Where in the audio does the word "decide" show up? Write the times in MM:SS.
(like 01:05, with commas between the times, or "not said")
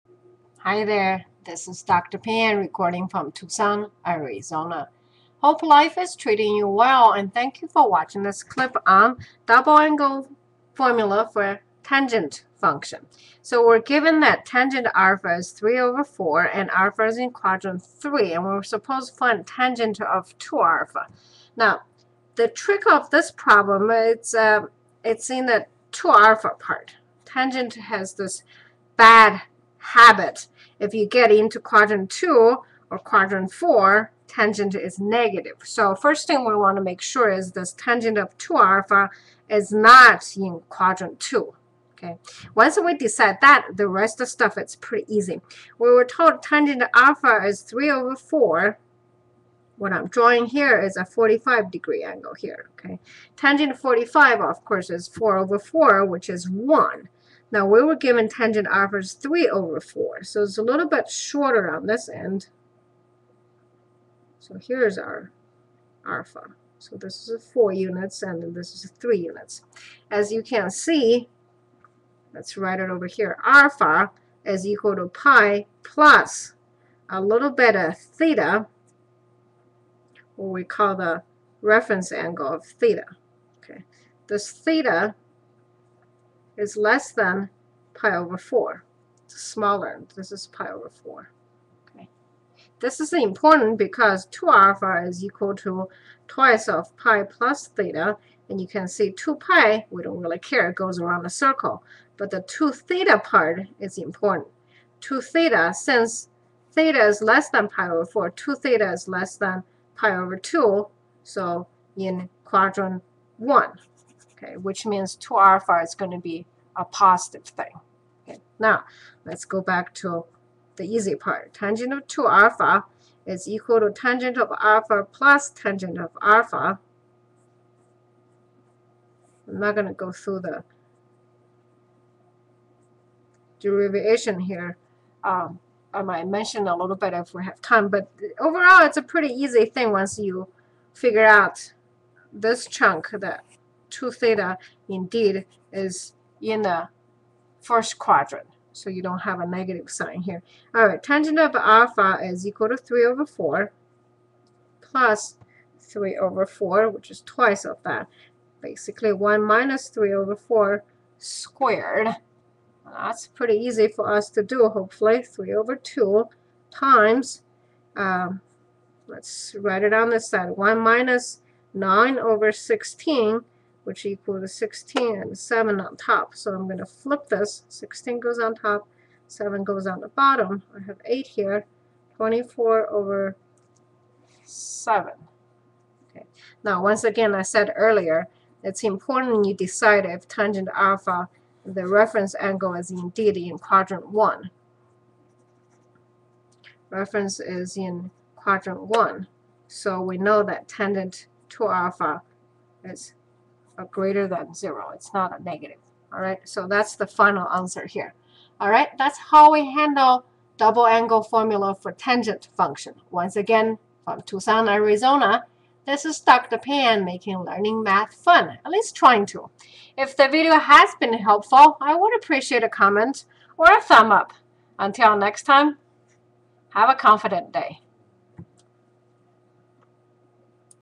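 00:42, 03:09.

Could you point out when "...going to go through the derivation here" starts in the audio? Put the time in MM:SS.
02:09.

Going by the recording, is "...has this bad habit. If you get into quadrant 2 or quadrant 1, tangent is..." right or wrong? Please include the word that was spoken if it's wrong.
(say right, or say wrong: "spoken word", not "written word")
wrong: "4", not "1".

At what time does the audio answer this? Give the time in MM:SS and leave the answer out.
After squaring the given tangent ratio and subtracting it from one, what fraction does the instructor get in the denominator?
02:50.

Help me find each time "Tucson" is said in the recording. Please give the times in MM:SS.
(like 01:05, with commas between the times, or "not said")
00:03, 03:34.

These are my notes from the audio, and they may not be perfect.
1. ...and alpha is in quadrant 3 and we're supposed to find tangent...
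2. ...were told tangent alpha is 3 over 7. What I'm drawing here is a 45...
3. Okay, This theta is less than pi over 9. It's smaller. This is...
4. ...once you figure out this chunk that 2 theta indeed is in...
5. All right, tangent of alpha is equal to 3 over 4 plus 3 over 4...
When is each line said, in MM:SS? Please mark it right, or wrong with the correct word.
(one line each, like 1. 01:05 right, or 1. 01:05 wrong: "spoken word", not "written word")
1. 00:16 right
2. 00:45 wrong: "4", not "7"
3. 01:23 wrong: "4", not "9"
4. 02:19 right
5. 02:30 right.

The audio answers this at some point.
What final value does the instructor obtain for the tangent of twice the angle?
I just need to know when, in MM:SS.
03:02.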